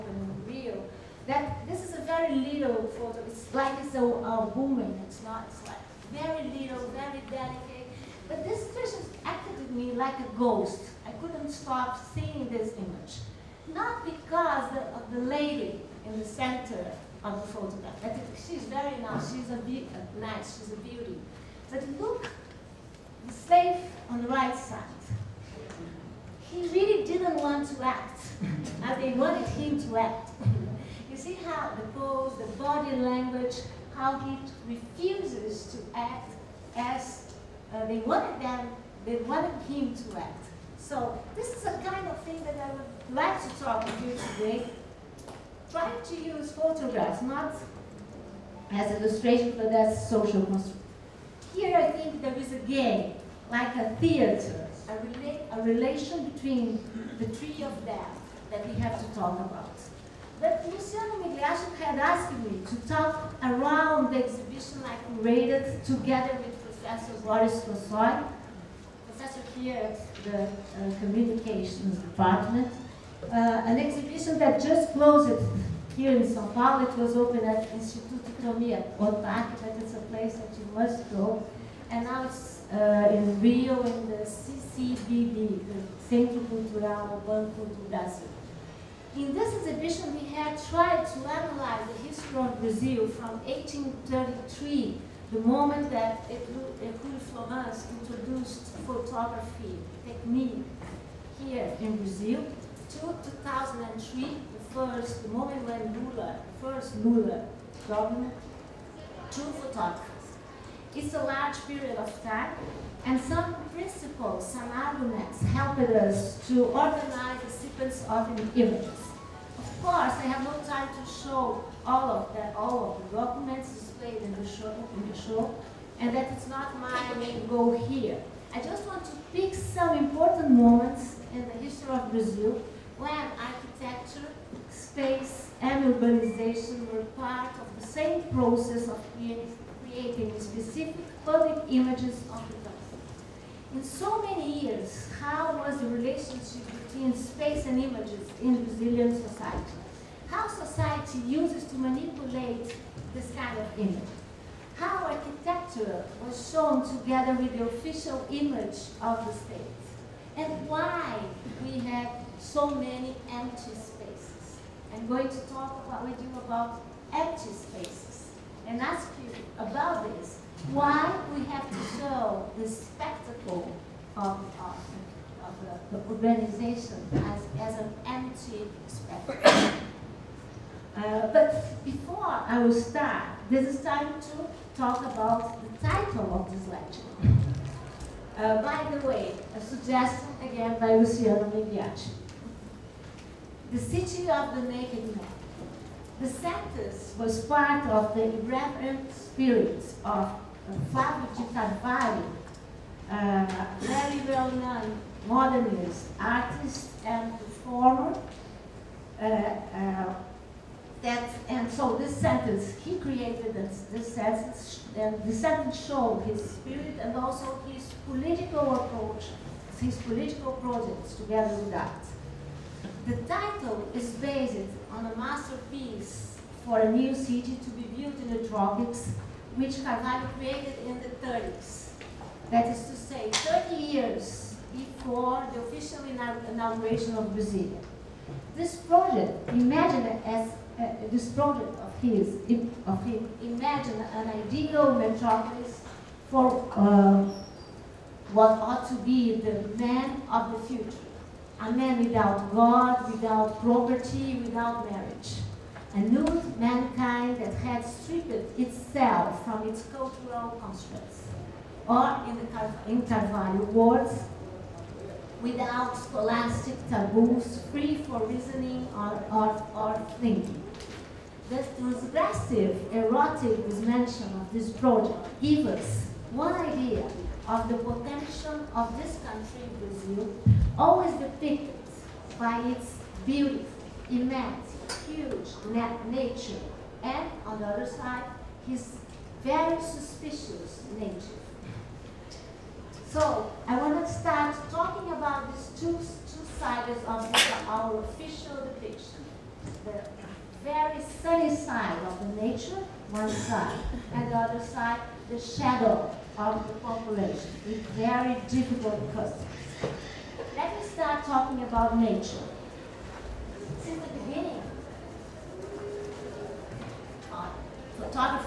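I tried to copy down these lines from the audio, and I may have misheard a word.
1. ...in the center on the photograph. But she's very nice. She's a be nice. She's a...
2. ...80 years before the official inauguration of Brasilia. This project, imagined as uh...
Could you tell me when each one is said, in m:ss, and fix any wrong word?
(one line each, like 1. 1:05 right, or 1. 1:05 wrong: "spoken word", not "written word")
1. 0:16 right
2. 3:53 wrong: "30", not "80".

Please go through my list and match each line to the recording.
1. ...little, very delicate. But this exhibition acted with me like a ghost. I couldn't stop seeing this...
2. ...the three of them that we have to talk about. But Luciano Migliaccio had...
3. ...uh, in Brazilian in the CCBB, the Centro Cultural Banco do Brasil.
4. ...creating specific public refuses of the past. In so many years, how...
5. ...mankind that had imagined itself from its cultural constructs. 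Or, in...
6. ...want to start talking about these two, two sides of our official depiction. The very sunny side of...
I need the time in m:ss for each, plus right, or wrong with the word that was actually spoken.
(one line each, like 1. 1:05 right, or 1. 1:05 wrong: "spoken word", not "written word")
1. 0:06 wrong: "person", not "exhibition"
2. 0:57 right
3. 1:22 wrong: "Rio", not "Brazilian"
4. 2:19 wrong: "images", not "refuses"
5. 4:16 wrong: "stripped", not "imagined"
6. 4:53 right.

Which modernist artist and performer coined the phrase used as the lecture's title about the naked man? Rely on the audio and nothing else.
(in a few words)
Flavio de Carvalho.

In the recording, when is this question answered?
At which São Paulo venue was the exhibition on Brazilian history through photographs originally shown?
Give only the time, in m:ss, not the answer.
1:17.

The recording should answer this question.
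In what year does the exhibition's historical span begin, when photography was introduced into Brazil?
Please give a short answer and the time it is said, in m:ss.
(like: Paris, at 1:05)
1833, at 1:33.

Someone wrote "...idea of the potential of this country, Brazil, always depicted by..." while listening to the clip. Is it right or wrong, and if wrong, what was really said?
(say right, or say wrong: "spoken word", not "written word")
right.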